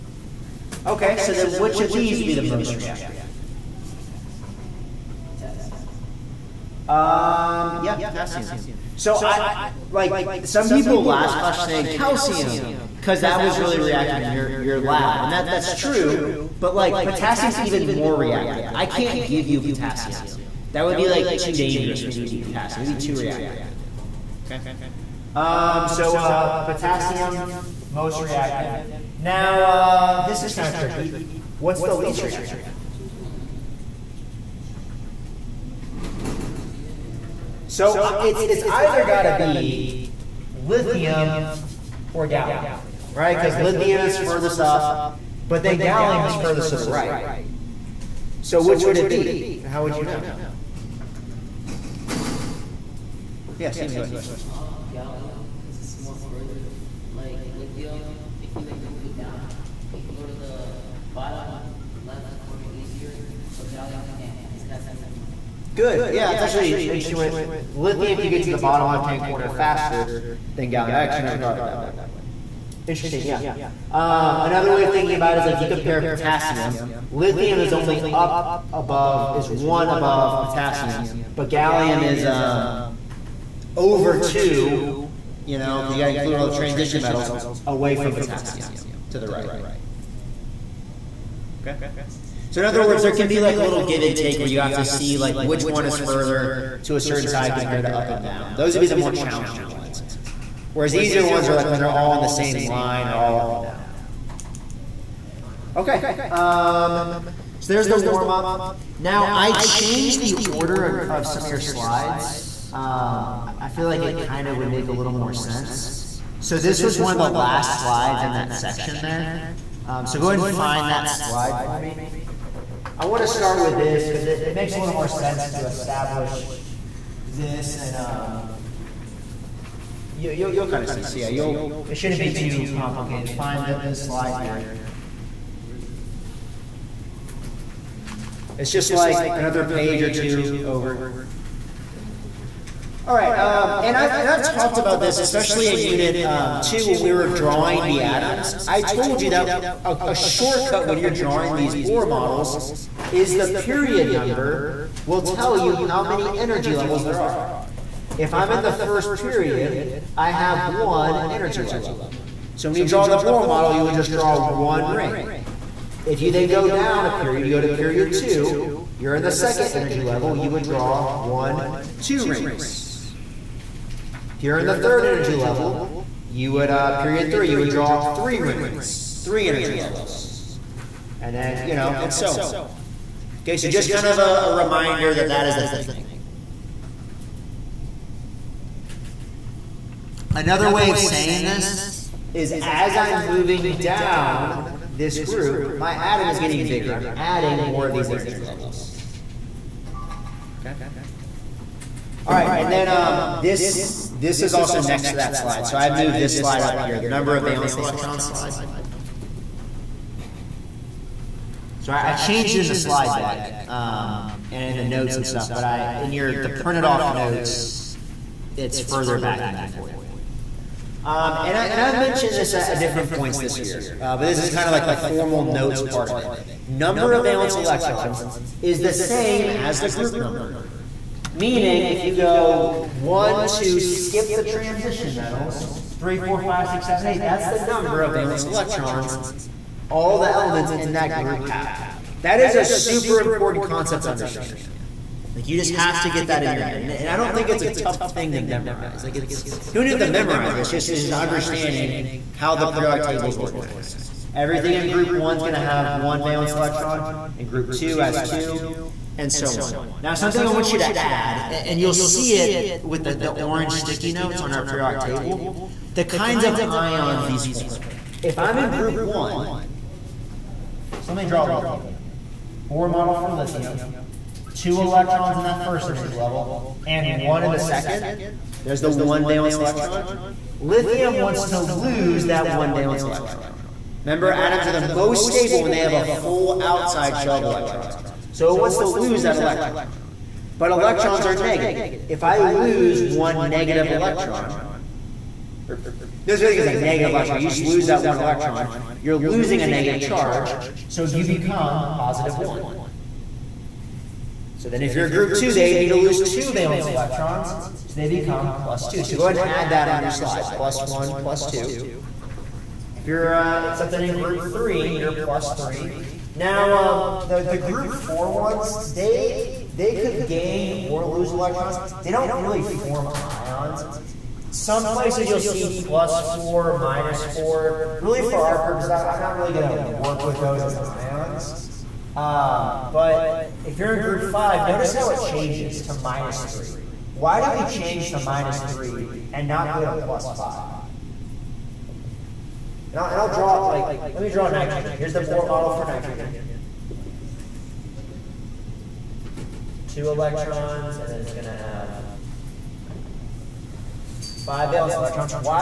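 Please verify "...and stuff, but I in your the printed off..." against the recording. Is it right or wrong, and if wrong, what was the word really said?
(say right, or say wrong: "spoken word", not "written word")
right.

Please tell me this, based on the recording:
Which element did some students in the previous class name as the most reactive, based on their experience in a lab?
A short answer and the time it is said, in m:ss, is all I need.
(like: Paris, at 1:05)
Calcium, at 0:11.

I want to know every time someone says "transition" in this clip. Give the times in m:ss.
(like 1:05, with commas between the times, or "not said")
1:26, 3:54.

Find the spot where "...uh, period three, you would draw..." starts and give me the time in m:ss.
2:56.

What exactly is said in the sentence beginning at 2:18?
It's just like another page or two over.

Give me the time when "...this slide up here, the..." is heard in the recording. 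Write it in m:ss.
3:26.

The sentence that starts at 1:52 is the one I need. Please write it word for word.
Um, I feel like it kind of would make a little more sense.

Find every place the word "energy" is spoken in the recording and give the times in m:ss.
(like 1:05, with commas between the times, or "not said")
2:36, 2:41, 2:49, 2:55, 2:59, 3:18, 4:35.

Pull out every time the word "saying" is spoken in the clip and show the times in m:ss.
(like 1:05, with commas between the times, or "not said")
0:11, 3:10.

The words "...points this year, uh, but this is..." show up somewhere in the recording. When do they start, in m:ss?
3:43.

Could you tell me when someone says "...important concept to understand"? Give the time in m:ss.
4:03.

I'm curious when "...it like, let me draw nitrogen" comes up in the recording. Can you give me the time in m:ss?
5:43.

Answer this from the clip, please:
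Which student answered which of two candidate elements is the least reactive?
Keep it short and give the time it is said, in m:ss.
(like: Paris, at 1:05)
Stephen, at 0:53.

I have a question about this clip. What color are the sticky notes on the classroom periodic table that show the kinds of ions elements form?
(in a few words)
Orange.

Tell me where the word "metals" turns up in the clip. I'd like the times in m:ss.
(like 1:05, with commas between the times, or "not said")
1:27, 3:55.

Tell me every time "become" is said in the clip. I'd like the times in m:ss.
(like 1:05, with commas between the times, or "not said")
5:01, 5:08.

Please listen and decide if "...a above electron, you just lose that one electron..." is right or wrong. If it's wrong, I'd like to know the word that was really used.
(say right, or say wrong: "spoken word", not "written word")
wrong: "negative", not "above".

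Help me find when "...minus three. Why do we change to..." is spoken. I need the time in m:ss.
5:35.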